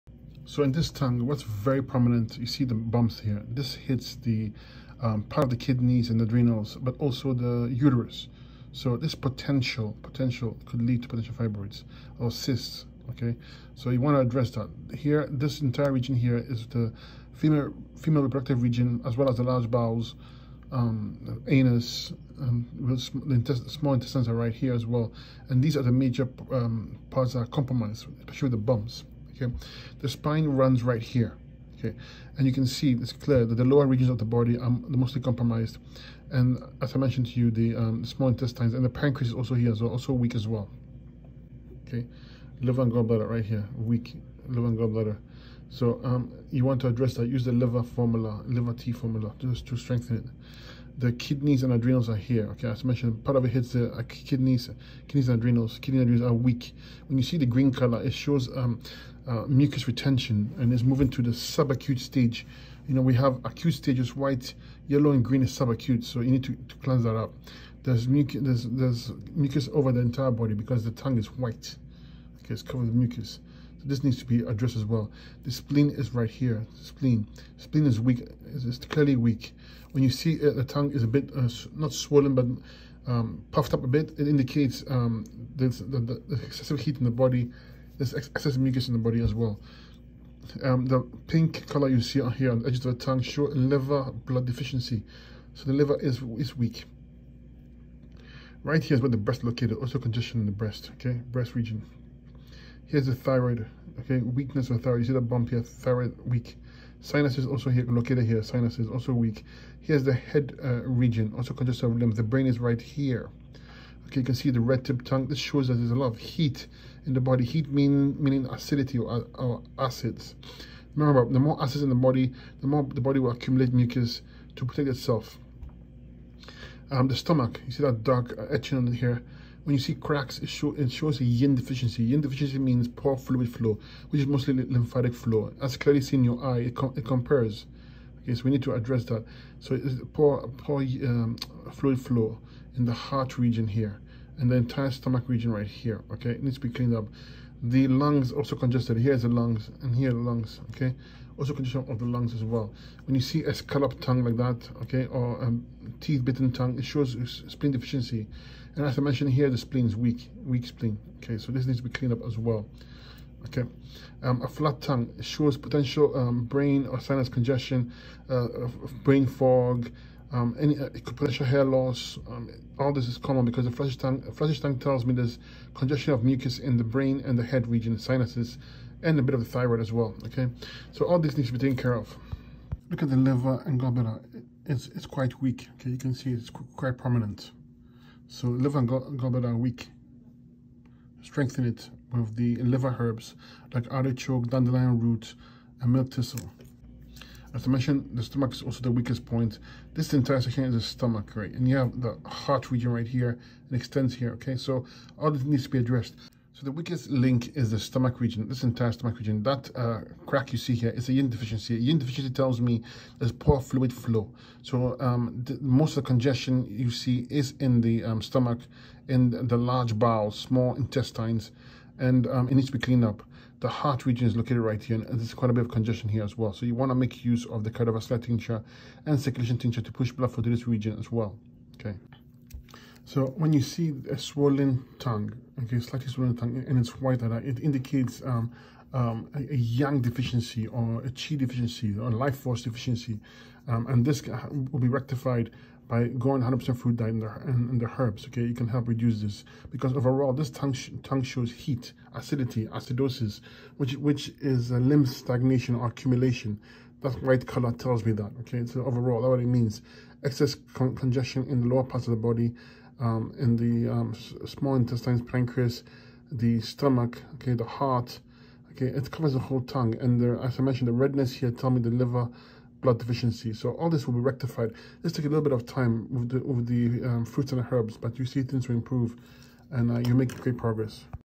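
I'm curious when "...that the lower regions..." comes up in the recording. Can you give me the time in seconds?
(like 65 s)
33 s.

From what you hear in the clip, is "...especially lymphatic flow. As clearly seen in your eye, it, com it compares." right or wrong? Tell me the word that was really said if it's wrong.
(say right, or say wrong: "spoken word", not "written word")
wrong: "mostly", not "especially".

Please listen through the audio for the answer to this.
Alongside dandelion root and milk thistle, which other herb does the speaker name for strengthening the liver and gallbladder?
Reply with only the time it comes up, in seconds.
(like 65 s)
193 s.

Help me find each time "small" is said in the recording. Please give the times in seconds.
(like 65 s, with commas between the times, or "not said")
23 s, 38 s, 220 s, 264 s.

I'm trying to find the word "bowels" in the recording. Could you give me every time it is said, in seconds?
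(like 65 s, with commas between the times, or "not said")
19 s, 219 s.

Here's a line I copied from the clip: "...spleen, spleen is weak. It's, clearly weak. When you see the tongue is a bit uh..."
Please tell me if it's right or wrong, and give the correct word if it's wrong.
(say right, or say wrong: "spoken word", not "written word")
right.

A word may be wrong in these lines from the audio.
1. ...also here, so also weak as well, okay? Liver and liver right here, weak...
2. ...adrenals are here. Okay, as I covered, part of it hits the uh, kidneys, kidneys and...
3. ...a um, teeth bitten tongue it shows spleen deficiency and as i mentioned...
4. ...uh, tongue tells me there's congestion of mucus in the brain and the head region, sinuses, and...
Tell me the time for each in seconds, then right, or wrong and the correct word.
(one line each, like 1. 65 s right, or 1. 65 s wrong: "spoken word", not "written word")
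1. 39 s wrong: "gallbladder", not "liver"
2. 51 s wrong: "mentioned", not "covered"
3. 155 s right
4. 174 s right.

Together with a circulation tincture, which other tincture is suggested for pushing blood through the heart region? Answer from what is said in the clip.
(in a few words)
Cardiovascular tincture.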